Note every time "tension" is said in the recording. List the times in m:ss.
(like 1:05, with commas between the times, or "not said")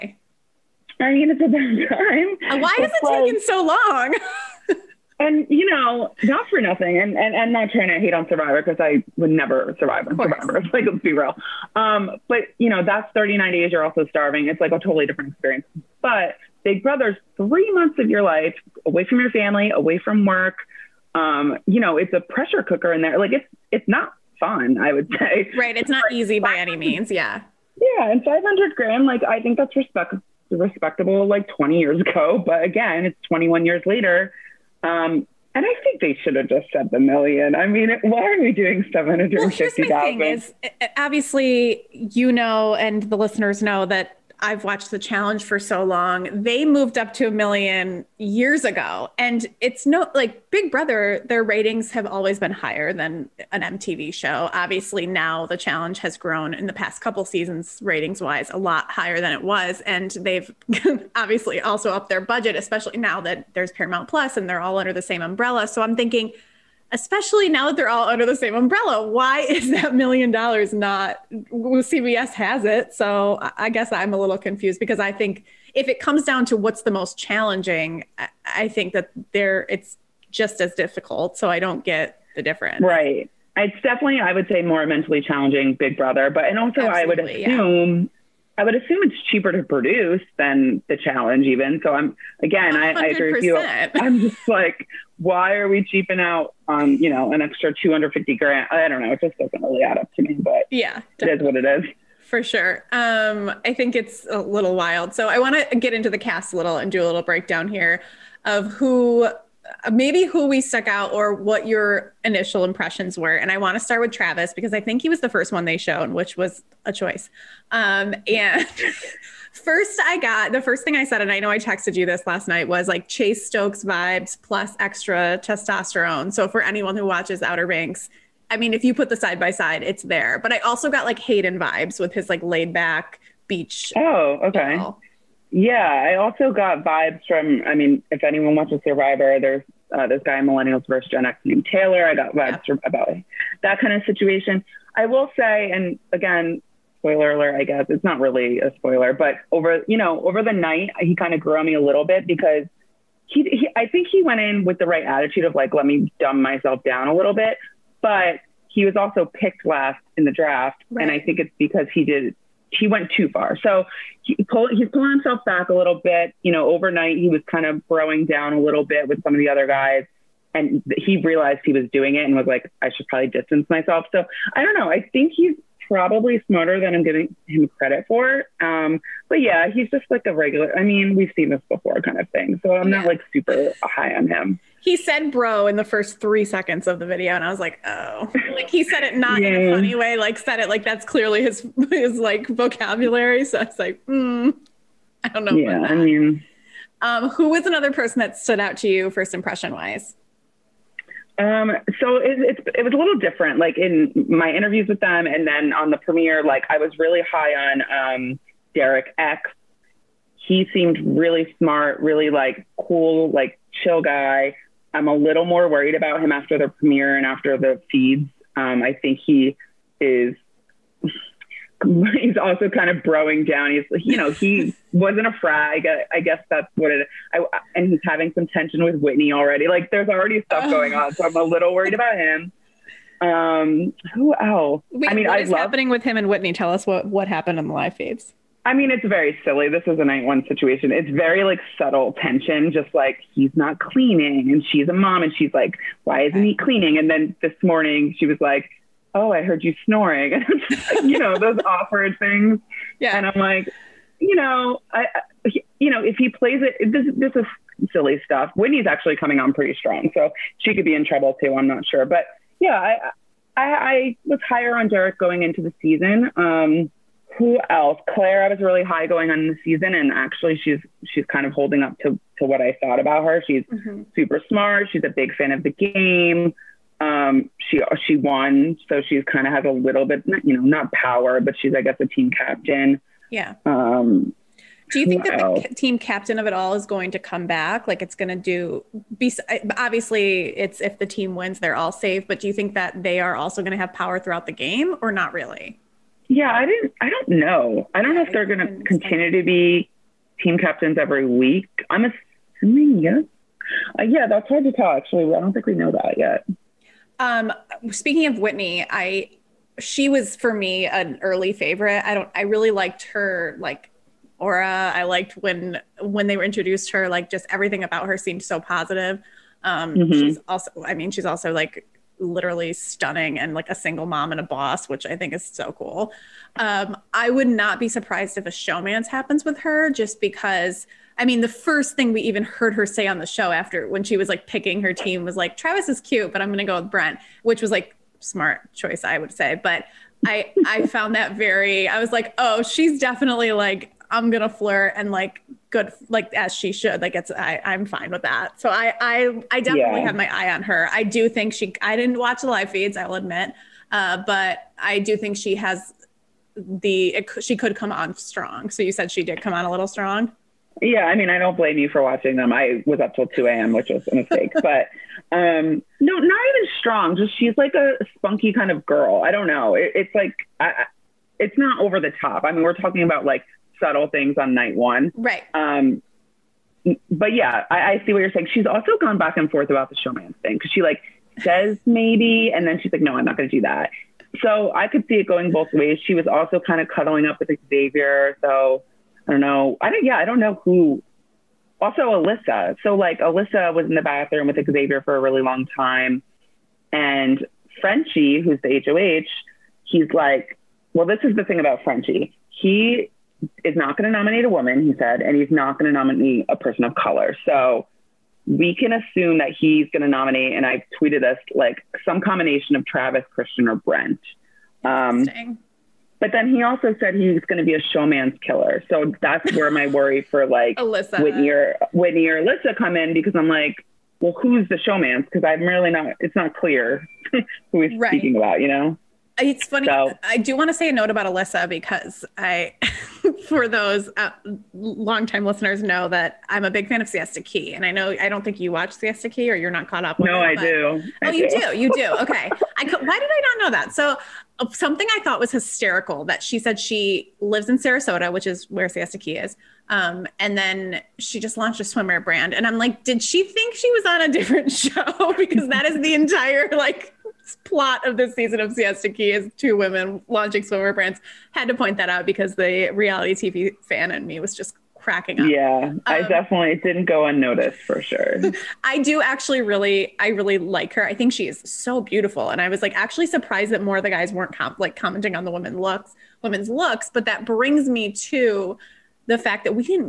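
3:48, 4:02.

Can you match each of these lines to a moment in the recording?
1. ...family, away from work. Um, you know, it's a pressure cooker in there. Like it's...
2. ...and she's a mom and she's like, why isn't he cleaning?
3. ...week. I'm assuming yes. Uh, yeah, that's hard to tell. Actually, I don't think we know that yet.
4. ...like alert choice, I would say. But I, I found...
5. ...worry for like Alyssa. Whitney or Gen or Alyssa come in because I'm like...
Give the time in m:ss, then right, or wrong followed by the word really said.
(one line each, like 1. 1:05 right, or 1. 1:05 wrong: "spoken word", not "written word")
1. 0:19 right
2. 4:04 right
3. 5:01 right
4. 5:37 wrong: "smart", not "alert"
5. 6:59 wrong: "Whitney", not "Gen".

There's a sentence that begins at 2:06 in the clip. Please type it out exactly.
So for anyone who watches Outer Banks, I mean, if you put the side by side, it's there.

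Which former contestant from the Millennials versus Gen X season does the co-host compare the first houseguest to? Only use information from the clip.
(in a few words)
Taylor.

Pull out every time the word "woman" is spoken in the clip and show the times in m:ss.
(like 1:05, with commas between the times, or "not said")
6:44.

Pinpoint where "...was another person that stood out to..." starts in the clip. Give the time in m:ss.
3:17.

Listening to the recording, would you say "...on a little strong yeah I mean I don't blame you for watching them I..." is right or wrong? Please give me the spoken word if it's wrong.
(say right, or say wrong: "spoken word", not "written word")
right.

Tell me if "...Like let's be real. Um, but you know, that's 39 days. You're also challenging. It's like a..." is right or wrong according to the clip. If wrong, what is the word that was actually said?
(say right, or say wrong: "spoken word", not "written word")
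wrong: "starving", not "challenging".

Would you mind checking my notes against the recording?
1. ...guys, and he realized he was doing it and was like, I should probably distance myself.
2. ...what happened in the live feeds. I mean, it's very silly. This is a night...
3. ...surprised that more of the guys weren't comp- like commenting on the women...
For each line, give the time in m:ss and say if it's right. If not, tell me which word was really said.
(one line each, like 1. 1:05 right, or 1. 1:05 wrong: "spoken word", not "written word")
1. 2:49 right
2. 3:57 right
3. 7:53 right.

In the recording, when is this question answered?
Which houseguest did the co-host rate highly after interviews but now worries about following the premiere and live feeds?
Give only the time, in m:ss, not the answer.
3:28.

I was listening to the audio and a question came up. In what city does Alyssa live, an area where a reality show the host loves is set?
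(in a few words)
Sarasota.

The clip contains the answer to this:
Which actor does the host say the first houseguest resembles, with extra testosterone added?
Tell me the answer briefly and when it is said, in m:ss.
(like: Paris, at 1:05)
Chase Stokes, at 2:03.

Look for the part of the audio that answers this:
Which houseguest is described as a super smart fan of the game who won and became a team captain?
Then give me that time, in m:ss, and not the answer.
4:28.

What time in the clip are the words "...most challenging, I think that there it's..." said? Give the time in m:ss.
1:16.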